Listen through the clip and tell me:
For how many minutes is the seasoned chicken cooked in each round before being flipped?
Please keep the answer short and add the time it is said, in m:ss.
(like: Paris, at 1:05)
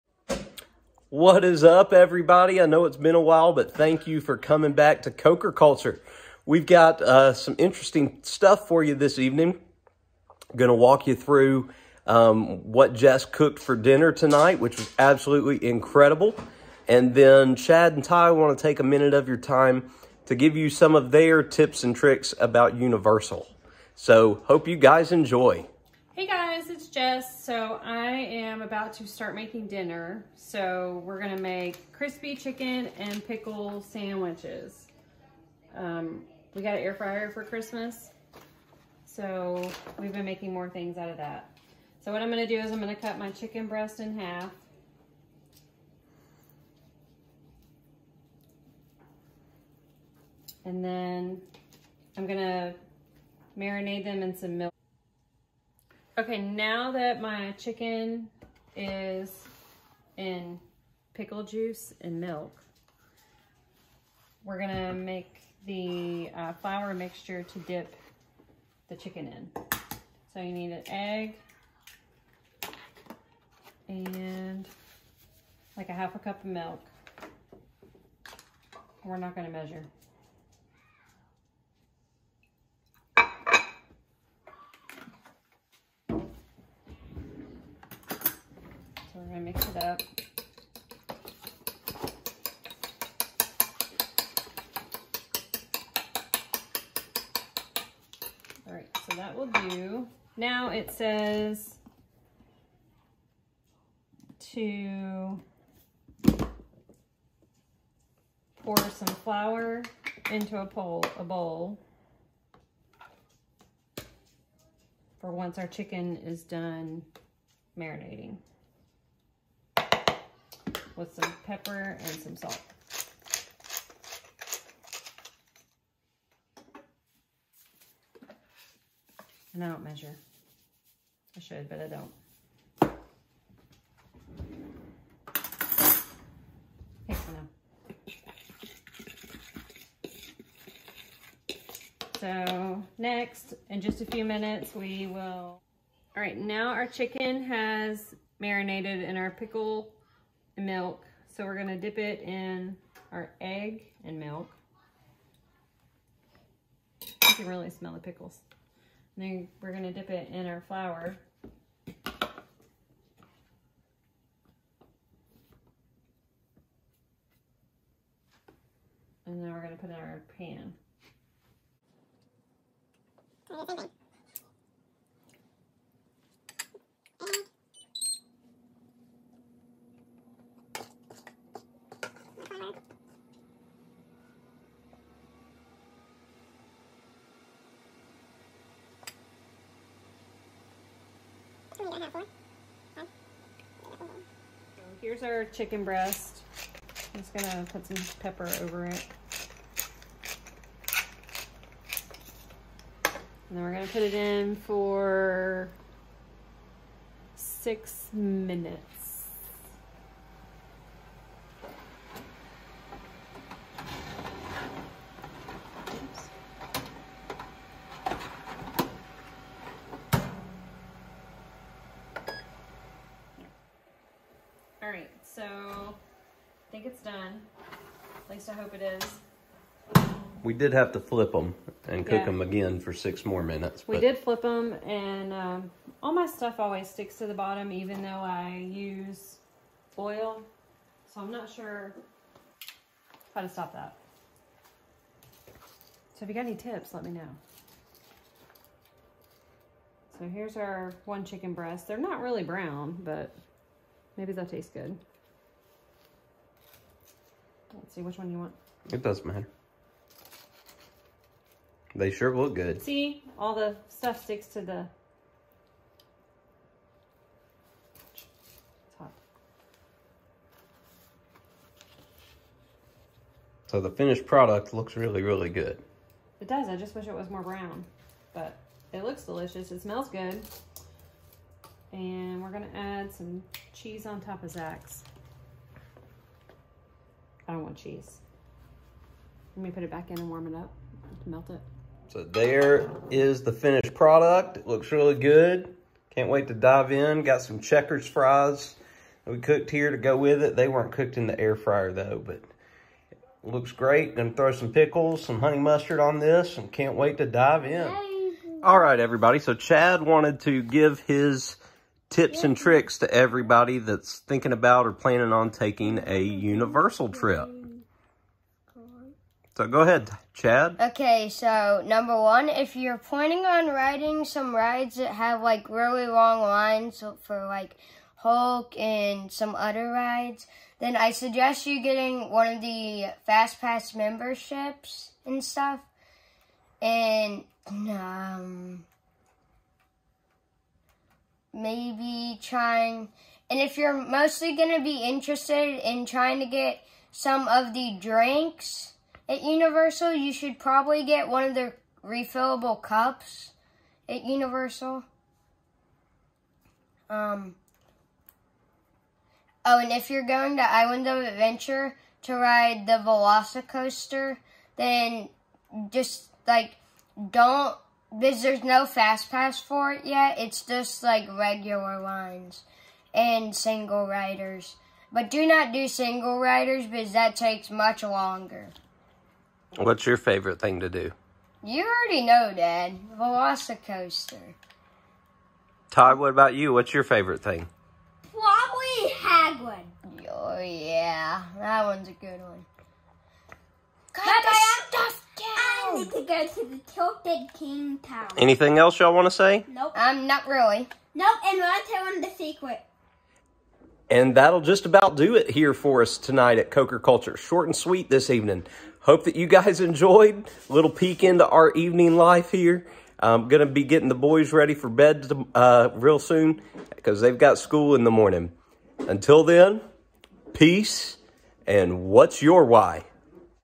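6, at 3:27.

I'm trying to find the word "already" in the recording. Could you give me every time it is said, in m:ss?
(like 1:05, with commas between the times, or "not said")
6:21.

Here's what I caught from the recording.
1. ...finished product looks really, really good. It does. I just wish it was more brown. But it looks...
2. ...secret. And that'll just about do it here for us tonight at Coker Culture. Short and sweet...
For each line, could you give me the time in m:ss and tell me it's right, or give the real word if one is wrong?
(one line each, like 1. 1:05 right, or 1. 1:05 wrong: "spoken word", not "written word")
1. 4:33 right
2. 6:42 right.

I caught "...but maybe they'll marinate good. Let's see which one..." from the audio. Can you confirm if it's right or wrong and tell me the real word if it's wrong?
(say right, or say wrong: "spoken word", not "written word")
wrong: "taste", not "marinate".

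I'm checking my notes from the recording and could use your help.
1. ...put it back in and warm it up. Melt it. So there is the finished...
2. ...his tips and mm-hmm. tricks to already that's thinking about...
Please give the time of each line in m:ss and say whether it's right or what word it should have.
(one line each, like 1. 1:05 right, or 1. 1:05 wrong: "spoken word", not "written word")
1. 4:49 right
2. 5:11 wrong: "everybody", not "already".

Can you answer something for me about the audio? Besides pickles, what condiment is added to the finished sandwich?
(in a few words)
Honey mustard.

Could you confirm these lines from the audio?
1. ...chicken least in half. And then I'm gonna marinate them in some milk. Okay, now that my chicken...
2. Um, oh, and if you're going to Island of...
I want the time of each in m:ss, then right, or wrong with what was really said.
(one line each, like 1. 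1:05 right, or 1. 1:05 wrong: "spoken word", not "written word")
1. 0:43 wrong: "breast", not "least"
2. 5:57 right.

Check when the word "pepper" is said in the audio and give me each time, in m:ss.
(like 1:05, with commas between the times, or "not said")
2:01, 3:18.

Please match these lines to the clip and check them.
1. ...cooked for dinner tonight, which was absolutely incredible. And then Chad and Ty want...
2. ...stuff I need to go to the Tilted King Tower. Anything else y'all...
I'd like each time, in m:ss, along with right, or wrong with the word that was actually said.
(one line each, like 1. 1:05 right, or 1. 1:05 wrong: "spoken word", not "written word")
1. 0:13 right
2. 6:34 right.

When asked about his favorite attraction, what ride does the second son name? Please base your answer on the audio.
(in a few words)
Hagrid.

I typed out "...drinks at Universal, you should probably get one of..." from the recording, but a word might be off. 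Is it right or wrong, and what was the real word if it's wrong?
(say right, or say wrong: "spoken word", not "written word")
right.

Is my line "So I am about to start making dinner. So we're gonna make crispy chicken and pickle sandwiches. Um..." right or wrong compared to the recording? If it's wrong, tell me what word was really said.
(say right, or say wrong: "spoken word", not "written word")
right.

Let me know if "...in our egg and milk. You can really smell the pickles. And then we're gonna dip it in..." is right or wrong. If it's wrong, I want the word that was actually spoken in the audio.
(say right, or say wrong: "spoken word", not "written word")
right.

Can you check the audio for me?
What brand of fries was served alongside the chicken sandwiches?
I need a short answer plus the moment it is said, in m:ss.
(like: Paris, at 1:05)
Checkers, at 4:57.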